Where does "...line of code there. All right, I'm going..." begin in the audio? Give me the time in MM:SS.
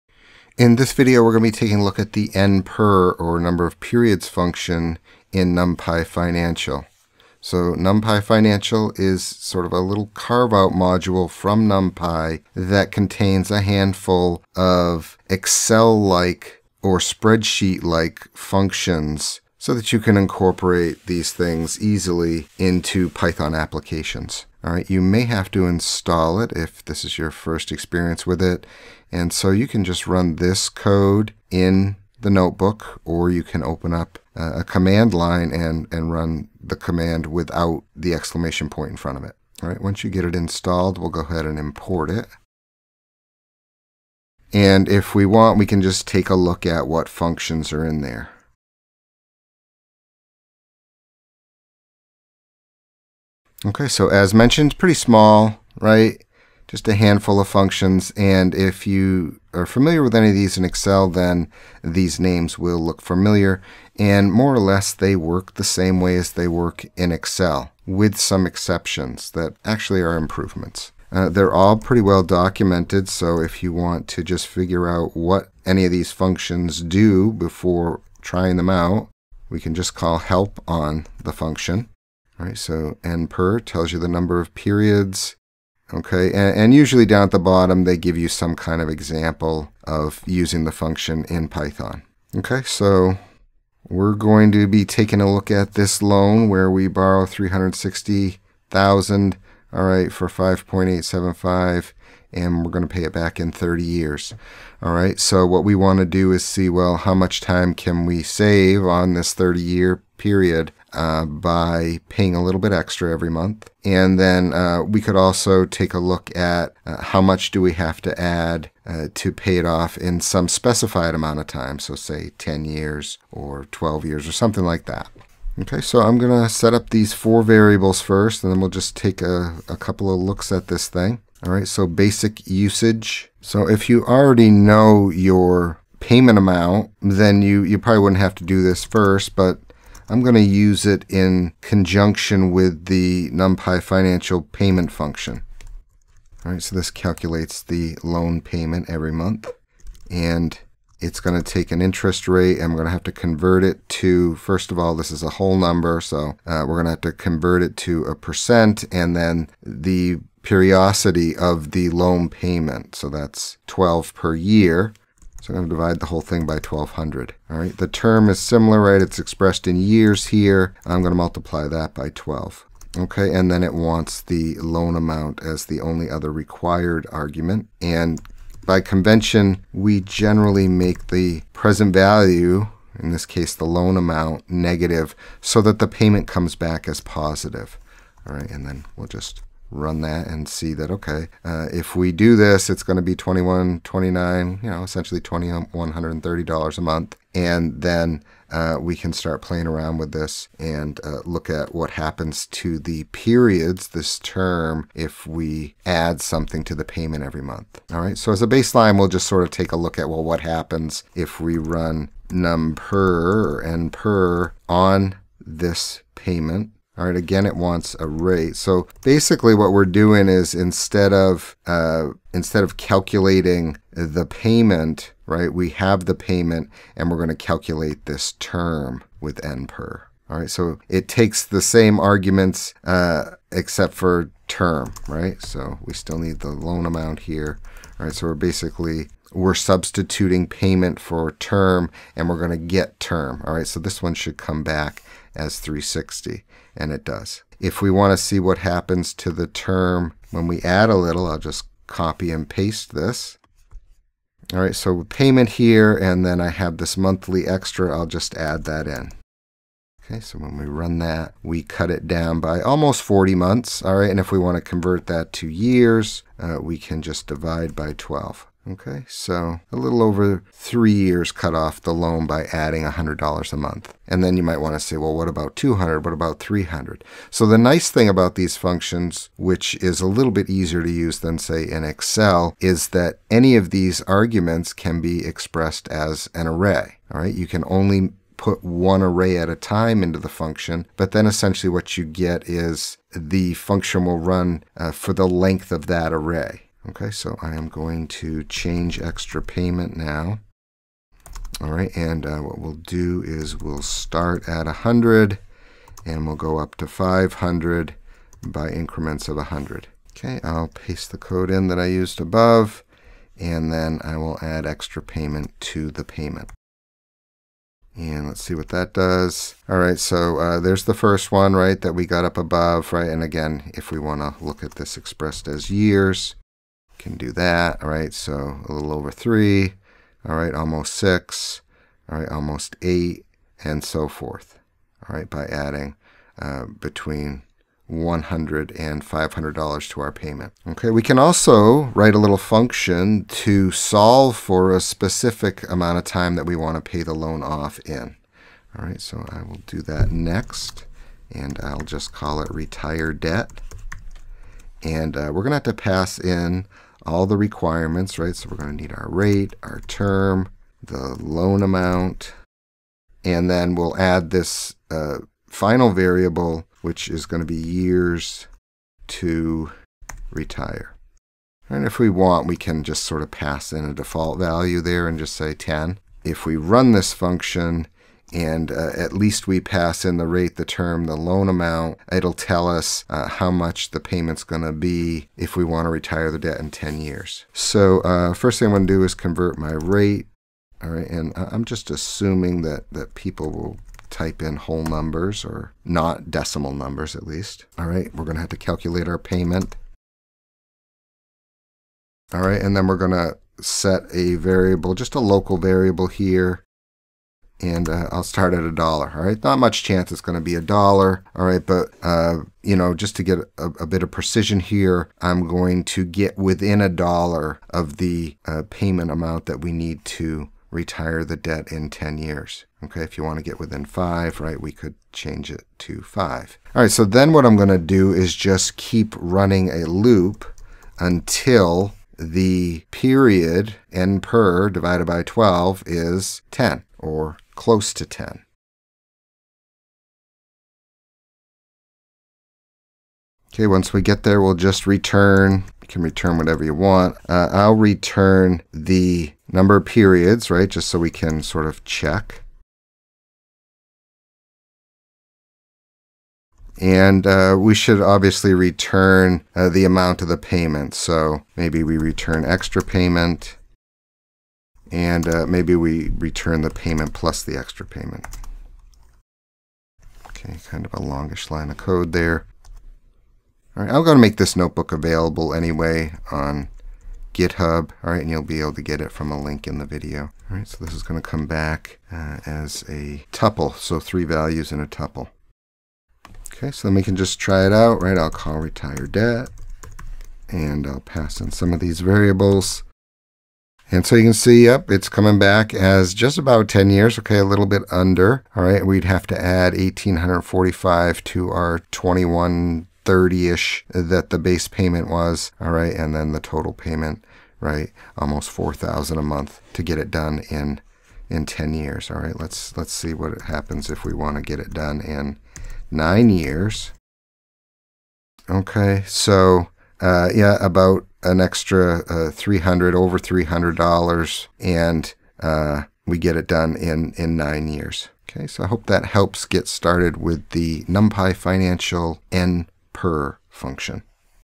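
07:51.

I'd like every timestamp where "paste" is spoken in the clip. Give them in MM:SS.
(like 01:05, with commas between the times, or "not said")
04:12, 05:10.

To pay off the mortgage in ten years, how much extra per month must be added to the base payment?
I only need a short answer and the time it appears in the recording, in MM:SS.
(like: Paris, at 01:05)
1845, at 08:19.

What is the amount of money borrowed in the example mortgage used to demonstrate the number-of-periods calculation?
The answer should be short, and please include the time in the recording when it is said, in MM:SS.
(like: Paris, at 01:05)
360,000, at 01:37.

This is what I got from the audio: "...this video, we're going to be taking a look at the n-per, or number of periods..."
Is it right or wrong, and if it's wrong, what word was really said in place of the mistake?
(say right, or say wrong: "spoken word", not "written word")
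right.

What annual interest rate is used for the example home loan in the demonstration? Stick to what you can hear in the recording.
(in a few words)
5.875.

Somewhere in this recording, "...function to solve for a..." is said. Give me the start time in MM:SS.
05:42.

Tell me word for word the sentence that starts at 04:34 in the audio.
And then you might want to say, well, what about 200?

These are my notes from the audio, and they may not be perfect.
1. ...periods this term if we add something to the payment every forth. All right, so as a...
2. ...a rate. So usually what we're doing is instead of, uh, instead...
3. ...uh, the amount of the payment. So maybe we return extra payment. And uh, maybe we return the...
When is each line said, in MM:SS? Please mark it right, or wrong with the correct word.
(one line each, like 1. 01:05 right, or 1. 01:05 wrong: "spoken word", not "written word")
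1. 03:23 wrong: "month", not "forth"
2. 03:37 wrong: "basically", not "usually"
3. 07:39 right.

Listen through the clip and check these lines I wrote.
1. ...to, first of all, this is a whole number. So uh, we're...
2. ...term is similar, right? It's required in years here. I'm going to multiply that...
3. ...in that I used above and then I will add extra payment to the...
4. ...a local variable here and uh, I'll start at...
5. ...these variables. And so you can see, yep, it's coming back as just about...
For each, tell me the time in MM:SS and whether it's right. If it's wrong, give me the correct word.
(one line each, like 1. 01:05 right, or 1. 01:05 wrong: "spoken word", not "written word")
1. 02:33 right
2. 02:47 wrong: "expressed", not "required"
3. 05:11 right
4. 06:45 right
5. 08:11 right.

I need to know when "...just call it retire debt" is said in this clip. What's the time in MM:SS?
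05:51.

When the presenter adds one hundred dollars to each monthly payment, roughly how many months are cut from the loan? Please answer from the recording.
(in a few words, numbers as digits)
almost 40.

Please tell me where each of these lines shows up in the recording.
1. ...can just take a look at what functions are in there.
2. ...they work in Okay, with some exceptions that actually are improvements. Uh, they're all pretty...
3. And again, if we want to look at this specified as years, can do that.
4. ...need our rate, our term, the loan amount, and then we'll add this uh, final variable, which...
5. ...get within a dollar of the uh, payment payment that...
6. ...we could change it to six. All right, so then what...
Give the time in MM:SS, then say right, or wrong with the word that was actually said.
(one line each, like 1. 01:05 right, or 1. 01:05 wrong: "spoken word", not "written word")
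1. 00:45 right
2. 01:06 wrong: "Excel", not "Okay"
3. 05:23 wrong: "expressed", not "specified"
4. 05:58 right
5. 06:56 wrong: "amount", not "payment"
6. 07:04 wrong: "five", not "six".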